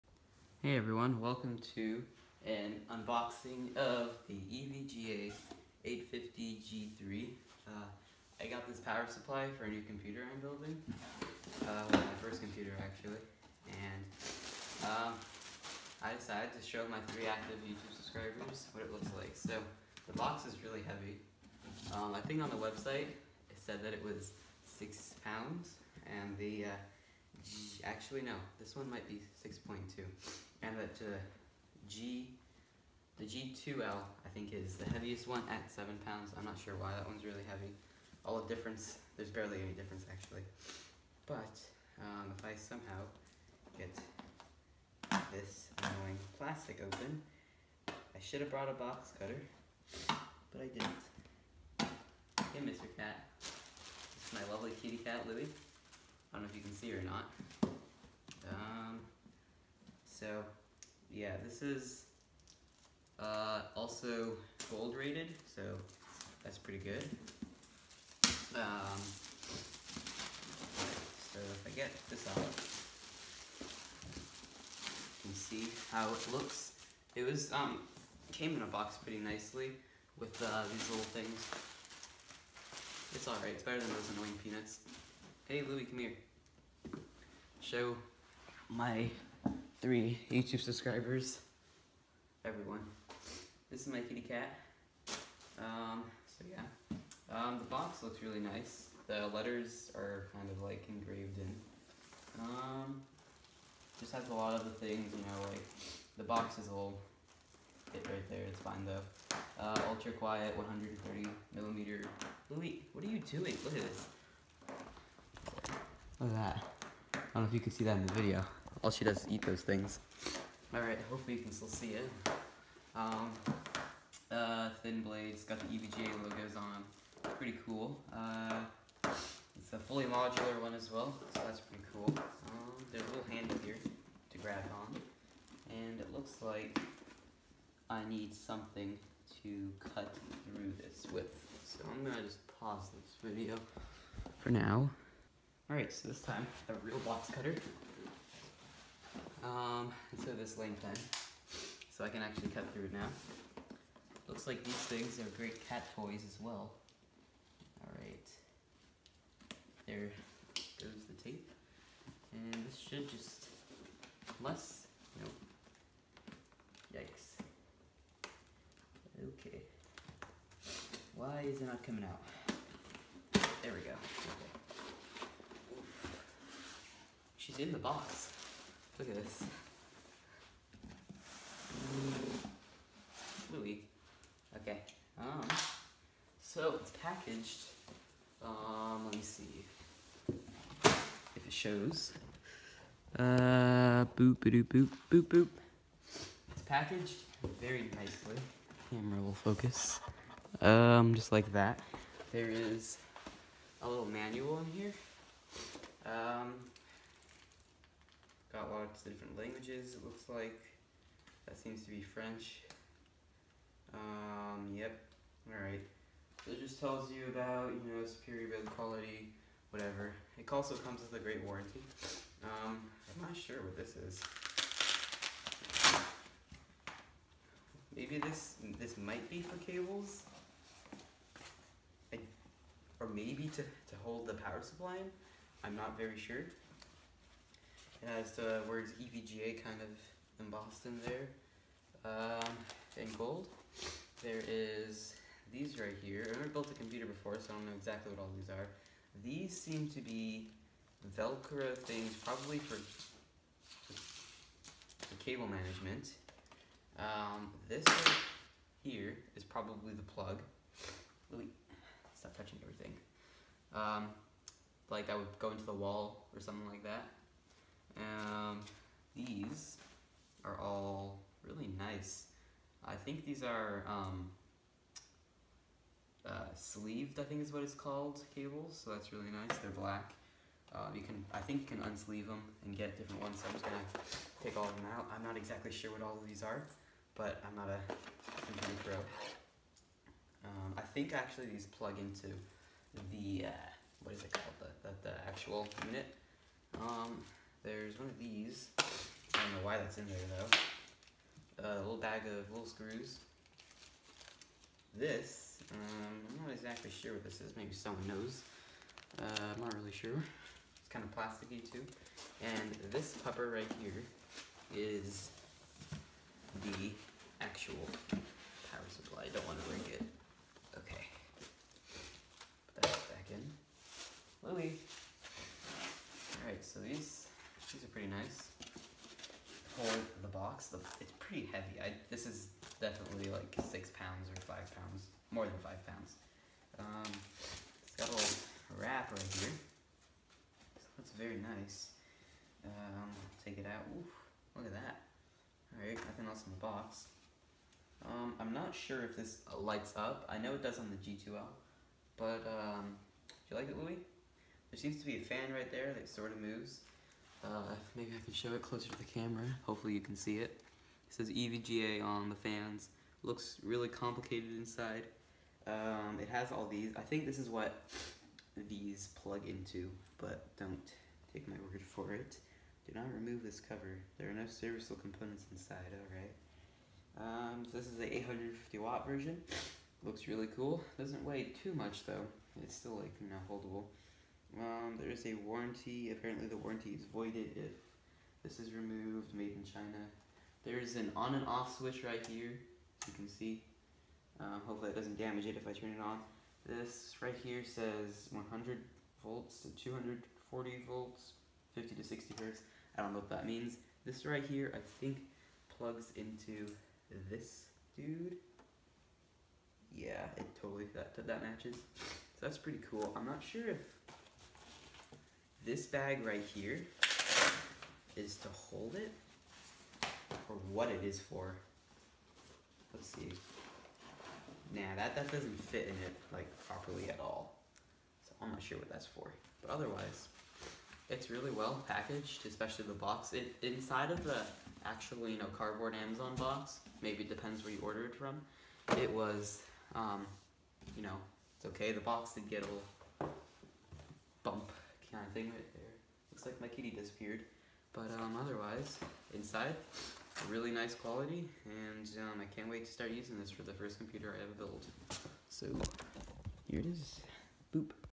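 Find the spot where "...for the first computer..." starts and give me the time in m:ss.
7:33.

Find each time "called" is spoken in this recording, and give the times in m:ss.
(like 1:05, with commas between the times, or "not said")
4:37, 4:54.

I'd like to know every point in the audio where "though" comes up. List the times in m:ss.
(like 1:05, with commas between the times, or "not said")
1:48, 5:01, 6:22.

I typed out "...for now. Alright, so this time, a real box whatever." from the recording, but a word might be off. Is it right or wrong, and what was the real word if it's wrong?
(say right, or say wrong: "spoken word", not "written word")
wrong: "cutter", not "whatever".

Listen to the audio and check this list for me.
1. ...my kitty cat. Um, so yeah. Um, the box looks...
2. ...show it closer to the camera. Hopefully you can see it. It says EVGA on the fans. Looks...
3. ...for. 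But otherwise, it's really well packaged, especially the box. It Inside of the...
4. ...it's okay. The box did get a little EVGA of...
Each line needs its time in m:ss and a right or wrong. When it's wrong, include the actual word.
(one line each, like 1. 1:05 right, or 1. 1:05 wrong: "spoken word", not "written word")
1. 1:33 right
2. 5:58 right
3. 7:09 right
4. 7:21 wrong: "Kind", not "EVGA".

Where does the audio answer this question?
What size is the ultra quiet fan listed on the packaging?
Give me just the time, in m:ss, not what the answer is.
1:50.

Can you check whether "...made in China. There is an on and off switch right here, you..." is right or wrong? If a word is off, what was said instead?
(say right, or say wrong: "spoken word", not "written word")
right.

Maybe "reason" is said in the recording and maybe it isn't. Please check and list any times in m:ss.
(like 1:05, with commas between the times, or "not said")
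not said.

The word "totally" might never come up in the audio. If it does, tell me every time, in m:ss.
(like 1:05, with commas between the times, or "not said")
6:50.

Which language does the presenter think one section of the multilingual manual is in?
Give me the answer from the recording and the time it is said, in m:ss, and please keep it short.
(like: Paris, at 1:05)
French, at 3:32.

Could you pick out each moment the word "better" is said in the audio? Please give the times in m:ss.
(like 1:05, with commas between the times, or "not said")
1:23.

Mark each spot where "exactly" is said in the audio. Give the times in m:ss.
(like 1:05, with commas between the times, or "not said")
4:07, 4:45, 5:06.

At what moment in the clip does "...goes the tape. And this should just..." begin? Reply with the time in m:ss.
2:40.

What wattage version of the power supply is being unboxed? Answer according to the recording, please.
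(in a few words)
850 watt.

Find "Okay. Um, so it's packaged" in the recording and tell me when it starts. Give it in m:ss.
3:04.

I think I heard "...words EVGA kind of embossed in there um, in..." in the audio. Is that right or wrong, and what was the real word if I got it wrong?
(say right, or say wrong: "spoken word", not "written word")
right.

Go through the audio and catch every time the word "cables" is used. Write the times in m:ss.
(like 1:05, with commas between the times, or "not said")
3:49, 4:15, 4:38.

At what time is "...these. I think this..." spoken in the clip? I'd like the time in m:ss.
6:06.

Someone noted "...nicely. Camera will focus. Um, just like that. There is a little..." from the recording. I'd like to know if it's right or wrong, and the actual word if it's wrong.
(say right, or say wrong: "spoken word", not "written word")
right.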